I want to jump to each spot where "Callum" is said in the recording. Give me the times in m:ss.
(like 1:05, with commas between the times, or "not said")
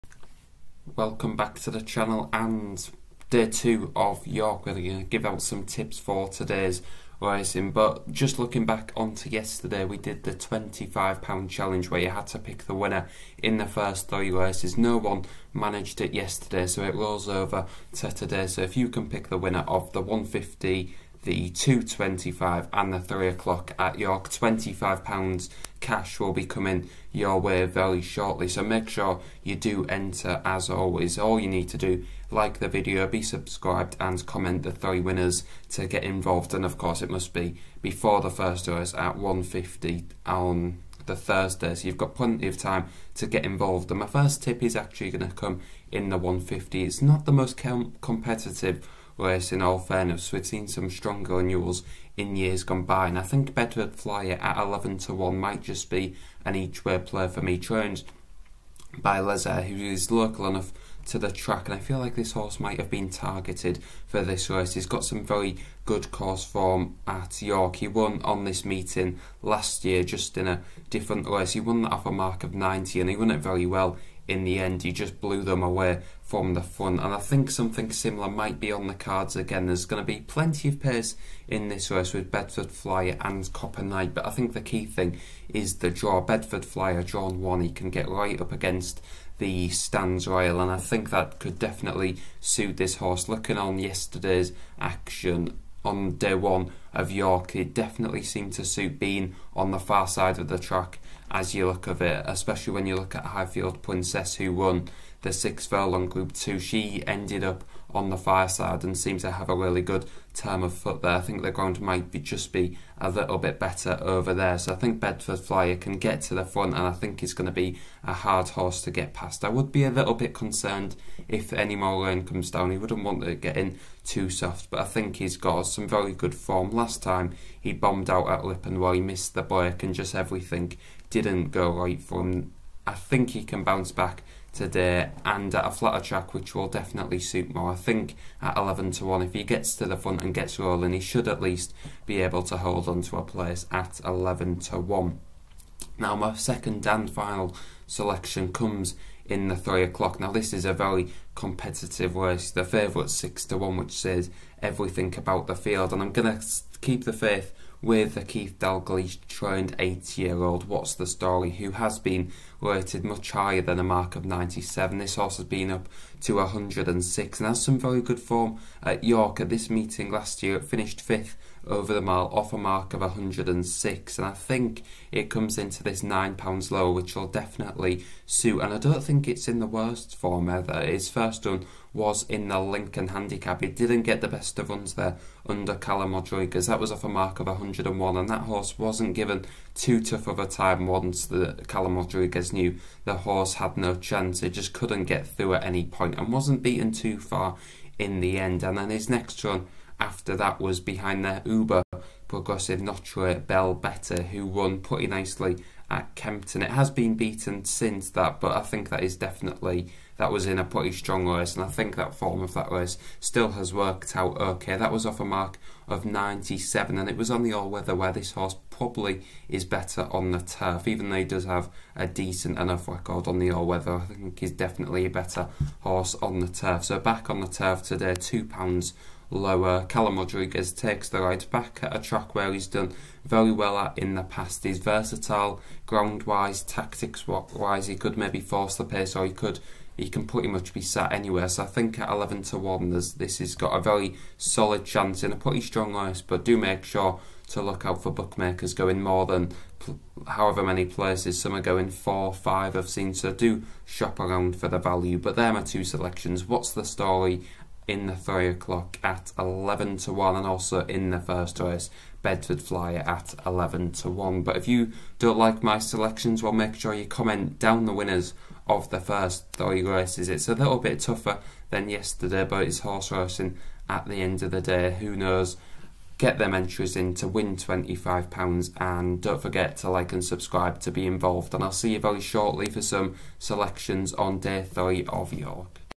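3:05, 3:11, 3:49.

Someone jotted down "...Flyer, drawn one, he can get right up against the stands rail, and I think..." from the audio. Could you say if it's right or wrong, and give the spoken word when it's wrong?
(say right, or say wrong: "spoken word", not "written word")
right.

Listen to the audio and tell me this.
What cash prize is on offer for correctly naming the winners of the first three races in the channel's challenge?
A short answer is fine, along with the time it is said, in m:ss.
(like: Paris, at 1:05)
£25, at 0:24.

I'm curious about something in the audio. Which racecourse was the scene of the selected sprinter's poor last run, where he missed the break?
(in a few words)
Ripon.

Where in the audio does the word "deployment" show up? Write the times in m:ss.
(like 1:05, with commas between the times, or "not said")
not said.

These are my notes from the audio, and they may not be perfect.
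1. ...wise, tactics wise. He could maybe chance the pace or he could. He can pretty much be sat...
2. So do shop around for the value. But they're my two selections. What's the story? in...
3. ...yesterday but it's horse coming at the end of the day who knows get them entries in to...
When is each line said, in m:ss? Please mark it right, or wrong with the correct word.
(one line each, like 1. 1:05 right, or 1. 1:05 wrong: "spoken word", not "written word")
1. 3:56 wrong: "force", not "chance"
2. 4:13 right
3. 4:31 wrong: "racing", not "coming".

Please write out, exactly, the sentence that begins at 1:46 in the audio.
She ended up on the far side and seem to have a really good term of foot there.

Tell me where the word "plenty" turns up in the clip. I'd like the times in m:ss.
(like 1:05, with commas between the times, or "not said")
0:42, 1:20.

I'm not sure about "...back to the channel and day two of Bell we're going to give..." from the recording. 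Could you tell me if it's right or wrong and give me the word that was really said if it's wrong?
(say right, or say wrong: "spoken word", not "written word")
wrong: "York", not "Bell".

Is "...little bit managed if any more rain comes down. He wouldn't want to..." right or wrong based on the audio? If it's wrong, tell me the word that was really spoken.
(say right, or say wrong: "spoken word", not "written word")
wrong: "concerned", not "managed".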